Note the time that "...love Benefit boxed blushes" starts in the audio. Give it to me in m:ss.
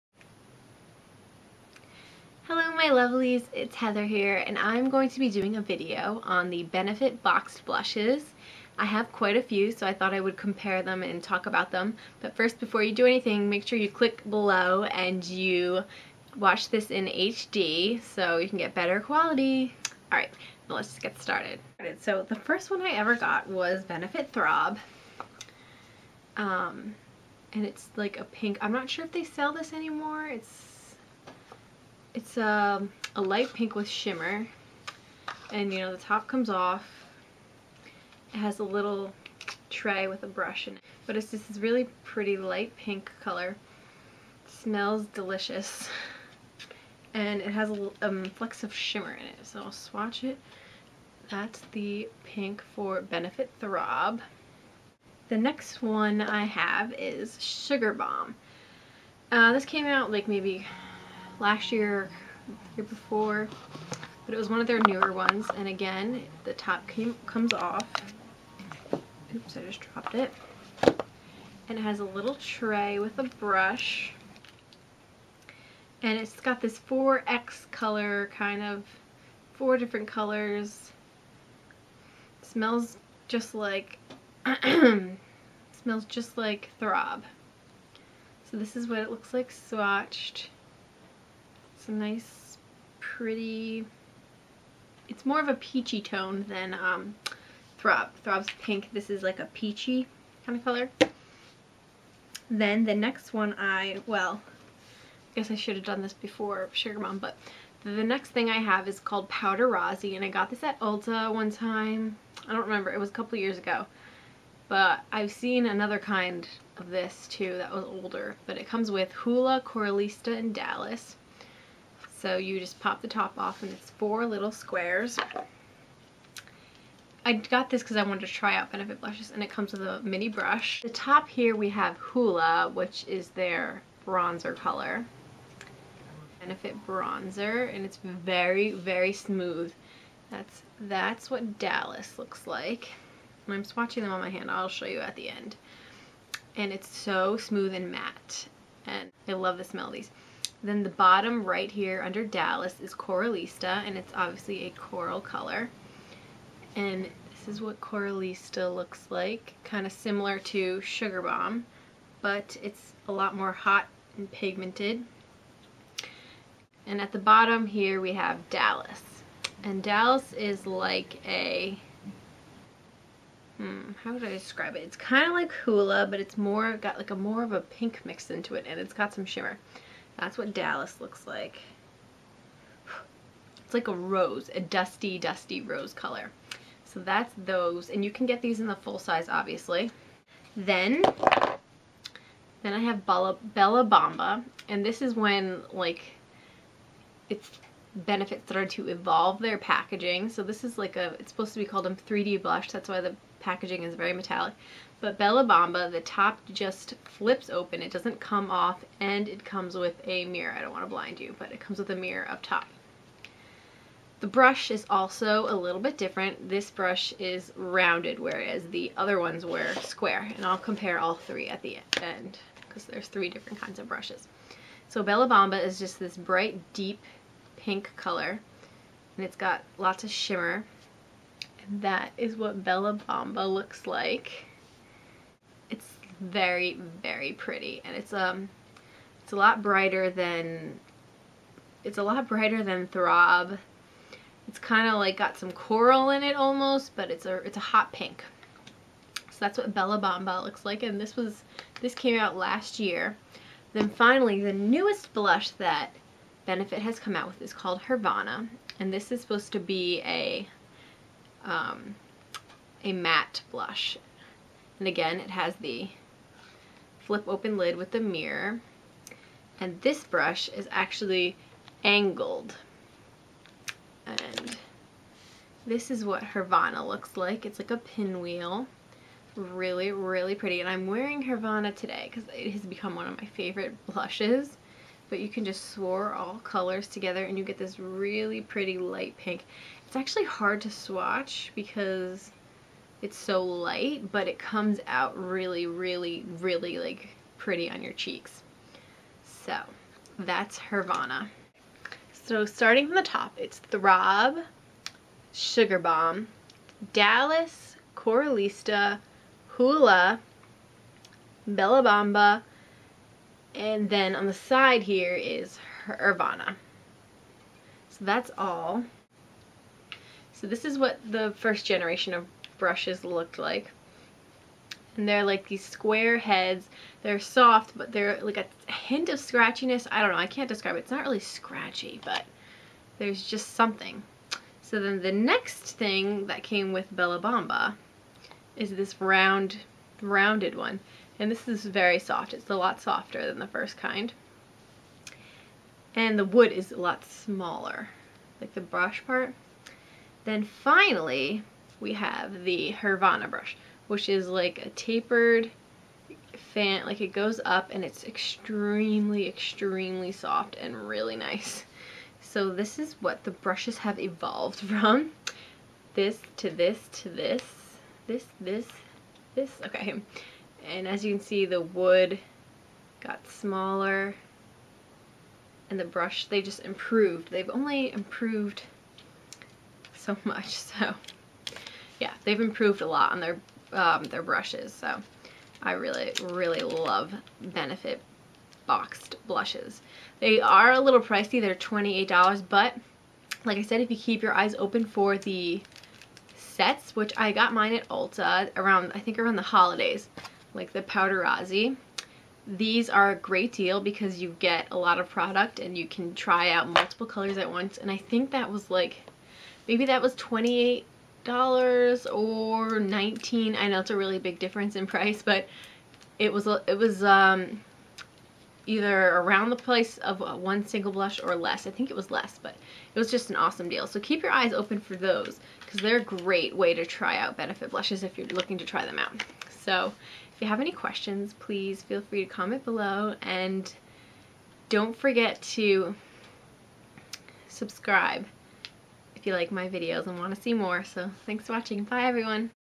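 6:26.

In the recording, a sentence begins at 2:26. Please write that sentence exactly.
And it's so smooth and matte.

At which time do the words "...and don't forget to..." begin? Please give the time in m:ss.
7:13.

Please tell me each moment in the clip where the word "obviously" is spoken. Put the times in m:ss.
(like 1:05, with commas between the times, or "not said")
2:34, 3:09.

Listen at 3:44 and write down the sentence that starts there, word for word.
So Bella Bamba is just this bright, deep pink color.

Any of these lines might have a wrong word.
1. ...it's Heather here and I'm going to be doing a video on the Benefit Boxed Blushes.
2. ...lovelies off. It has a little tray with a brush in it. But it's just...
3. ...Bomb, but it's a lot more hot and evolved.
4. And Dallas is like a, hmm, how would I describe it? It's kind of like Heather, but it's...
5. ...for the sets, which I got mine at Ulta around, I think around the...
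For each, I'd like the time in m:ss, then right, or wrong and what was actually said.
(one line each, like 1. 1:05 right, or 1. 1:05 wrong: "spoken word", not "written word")
1. 0:03 right
2. 0:36 wrong: "comes", not "lovelies"
3. 2:41 wrong: "pigmented", not "evolved"
4. 2:49 wrong: "Hoola", not "Heather"
5. 6:34 right.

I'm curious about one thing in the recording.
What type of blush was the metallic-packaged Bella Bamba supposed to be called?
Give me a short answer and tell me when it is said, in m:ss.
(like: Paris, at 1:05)
3D blush, at 3:21.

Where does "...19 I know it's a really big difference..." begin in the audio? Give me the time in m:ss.
6:52.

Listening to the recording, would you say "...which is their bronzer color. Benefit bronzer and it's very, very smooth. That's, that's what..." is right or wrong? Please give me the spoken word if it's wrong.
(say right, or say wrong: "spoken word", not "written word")
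right.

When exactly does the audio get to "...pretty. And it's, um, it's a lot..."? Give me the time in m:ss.
3:57.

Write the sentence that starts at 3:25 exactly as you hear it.
But Bella Bamba, the top just flips open.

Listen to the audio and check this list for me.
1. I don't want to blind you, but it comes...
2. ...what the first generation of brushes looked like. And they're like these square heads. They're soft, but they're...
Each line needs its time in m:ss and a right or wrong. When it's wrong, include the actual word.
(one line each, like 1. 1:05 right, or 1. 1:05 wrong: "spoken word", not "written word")
1. 3:30 right
2. 5:20 right.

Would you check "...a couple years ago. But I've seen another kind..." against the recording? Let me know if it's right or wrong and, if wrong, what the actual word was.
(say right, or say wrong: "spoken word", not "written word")
right.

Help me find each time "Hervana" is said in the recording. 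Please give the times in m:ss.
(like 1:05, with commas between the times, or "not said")
4:17, 4:36, 4:41, 5:00, 5:15, 5:52.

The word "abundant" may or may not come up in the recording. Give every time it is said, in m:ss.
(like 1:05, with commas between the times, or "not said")
not said.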